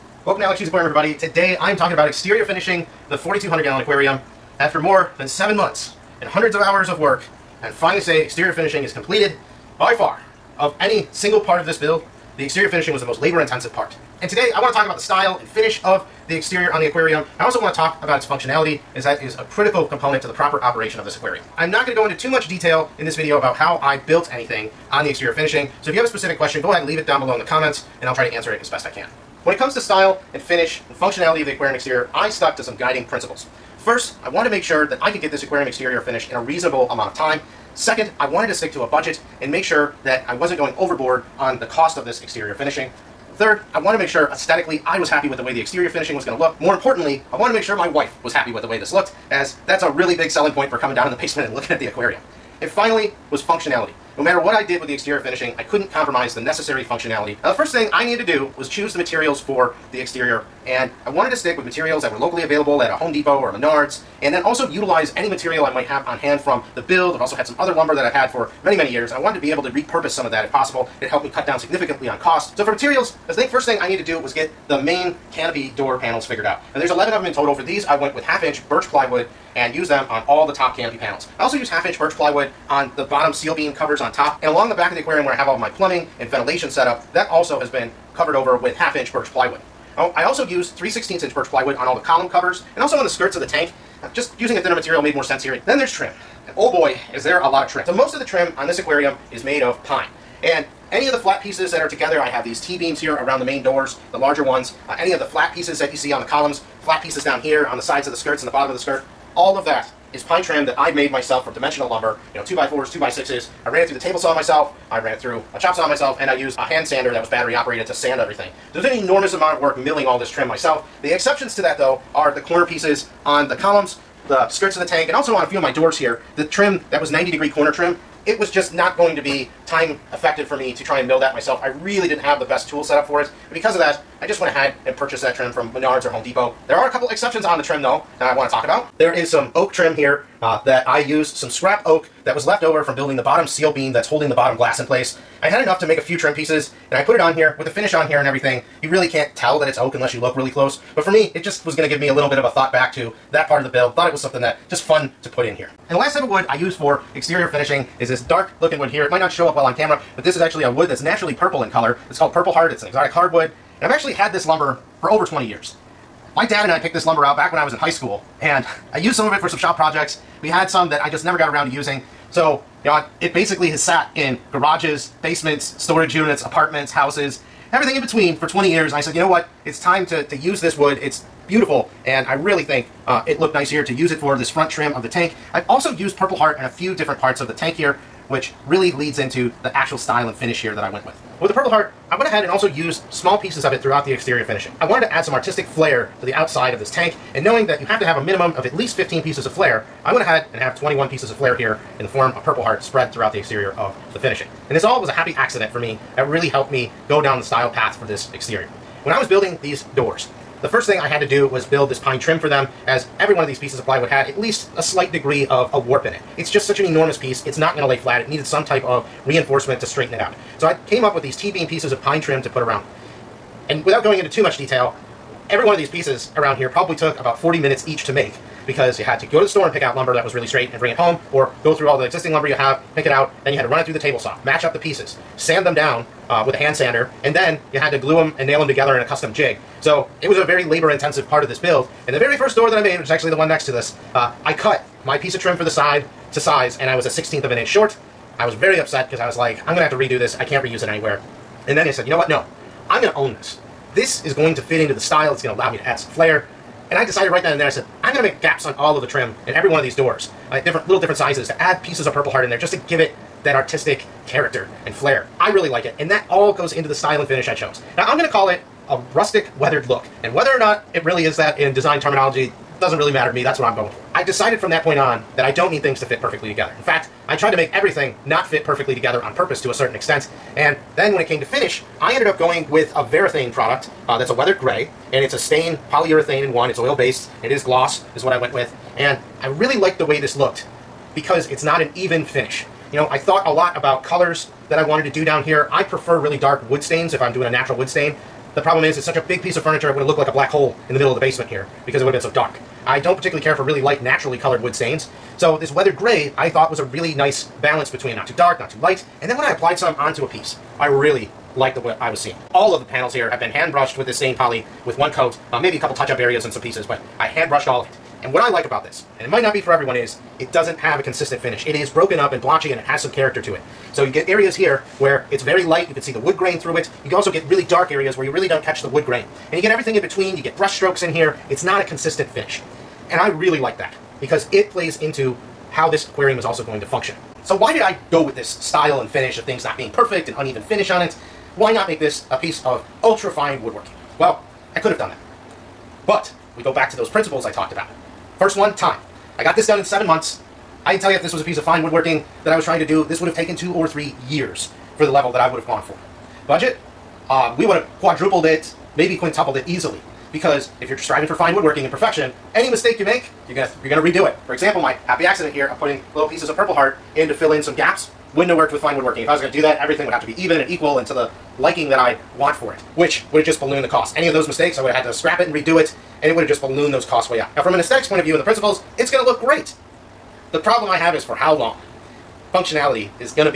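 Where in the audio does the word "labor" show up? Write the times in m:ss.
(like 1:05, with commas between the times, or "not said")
0:13, 4:00.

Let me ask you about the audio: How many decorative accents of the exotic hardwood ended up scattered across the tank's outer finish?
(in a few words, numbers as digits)
21.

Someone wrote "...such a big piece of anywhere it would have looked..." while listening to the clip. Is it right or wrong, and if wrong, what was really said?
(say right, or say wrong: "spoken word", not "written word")
wrong: "furniture", not "anywhere".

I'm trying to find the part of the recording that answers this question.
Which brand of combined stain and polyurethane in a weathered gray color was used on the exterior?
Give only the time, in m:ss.
4:43.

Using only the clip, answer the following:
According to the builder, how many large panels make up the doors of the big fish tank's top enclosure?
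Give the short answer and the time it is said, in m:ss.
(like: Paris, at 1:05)
11, at 1:16.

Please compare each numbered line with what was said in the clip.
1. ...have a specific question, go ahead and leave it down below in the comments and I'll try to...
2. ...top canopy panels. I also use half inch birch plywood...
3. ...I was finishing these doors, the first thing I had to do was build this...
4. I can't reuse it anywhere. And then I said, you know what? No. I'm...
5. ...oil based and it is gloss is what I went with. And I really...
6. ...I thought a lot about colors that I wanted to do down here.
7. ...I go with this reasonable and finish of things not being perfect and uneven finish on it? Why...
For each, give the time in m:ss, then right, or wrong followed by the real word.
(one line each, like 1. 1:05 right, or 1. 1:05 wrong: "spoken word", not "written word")
1. 0:25 right
2. 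1:20 right
3. 3:29 wrong: "building", not "finishing"
4. 4:10 right
5. 4:46 right
6. 4:53 right
7. 5:37 wrong: "style", not "reasonable".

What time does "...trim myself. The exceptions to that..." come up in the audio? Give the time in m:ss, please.
2:00.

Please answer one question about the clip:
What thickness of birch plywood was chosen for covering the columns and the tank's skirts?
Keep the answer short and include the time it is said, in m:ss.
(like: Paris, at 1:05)
3/16 inch, at 1:30.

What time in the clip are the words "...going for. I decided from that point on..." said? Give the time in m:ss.
4:33.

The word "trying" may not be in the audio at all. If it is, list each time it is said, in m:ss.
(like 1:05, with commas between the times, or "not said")
5:52.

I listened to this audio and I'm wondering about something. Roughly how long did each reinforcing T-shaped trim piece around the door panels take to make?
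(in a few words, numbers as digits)
40 minutes.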